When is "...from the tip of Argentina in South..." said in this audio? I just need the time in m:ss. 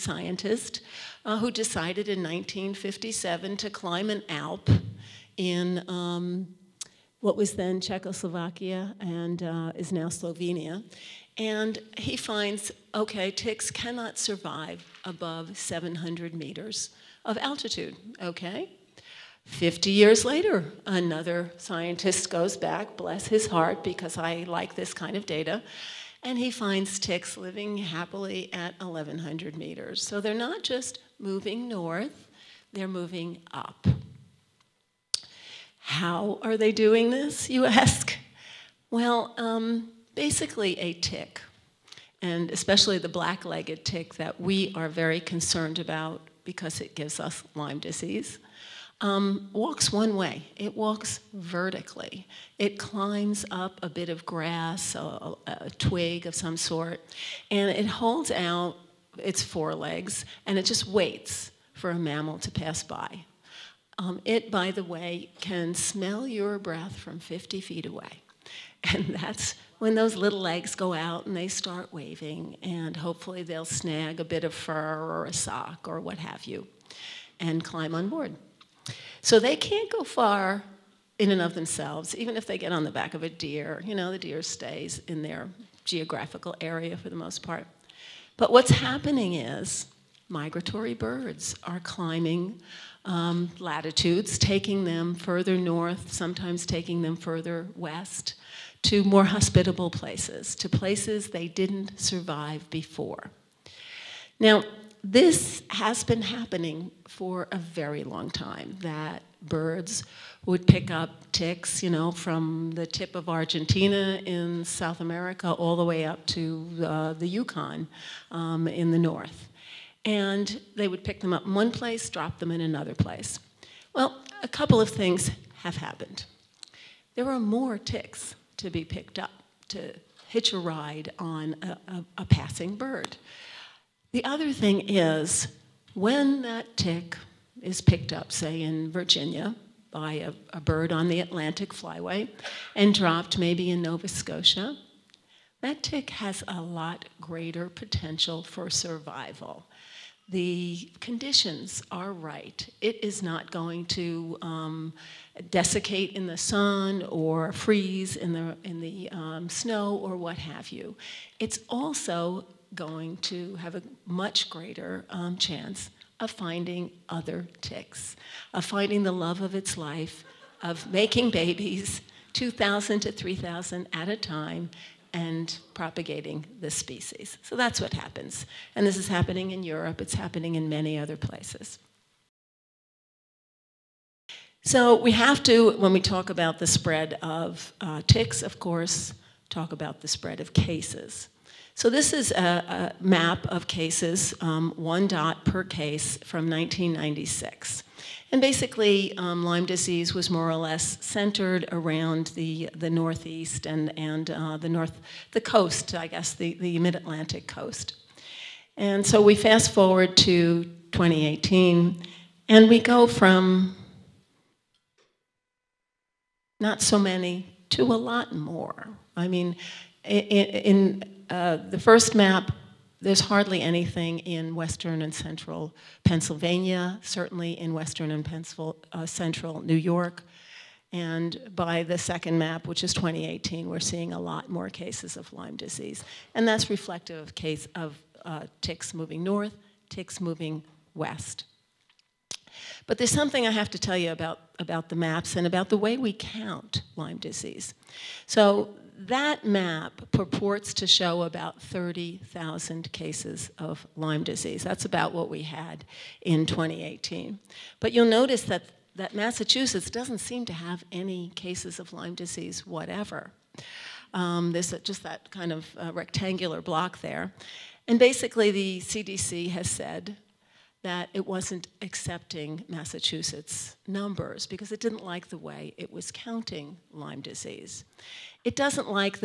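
1:52.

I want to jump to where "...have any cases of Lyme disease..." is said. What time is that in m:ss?
4:20.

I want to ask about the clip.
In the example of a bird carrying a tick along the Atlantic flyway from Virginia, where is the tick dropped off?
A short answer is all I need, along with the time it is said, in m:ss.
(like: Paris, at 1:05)
Nova Scotia, at 2:23.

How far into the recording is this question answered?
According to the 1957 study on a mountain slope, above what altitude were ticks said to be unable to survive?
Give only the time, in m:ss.
0:15.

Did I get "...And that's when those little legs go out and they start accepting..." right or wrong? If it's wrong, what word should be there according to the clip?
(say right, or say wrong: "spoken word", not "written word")
wrong: "waving", not "accepting".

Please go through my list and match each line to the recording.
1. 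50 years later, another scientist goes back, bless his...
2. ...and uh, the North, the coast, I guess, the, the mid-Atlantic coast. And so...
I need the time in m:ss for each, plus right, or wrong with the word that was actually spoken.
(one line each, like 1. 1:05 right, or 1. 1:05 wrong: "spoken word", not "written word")
1. 0:19 right
2. 3:23 right.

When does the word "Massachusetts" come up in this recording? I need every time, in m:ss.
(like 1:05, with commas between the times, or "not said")
4:19, 4:32.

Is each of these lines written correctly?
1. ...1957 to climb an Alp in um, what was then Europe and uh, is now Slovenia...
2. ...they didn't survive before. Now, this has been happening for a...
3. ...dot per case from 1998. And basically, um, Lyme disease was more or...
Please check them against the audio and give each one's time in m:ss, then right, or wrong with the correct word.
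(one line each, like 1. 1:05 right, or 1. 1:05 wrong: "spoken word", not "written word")
1. 0:02 wrong: "Czechoslovakia", not "Europe"
2. 1:41 right
3. 3:15 wrong: "1996", not "1998".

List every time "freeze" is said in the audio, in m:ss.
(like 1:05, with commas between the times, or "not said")
2:37.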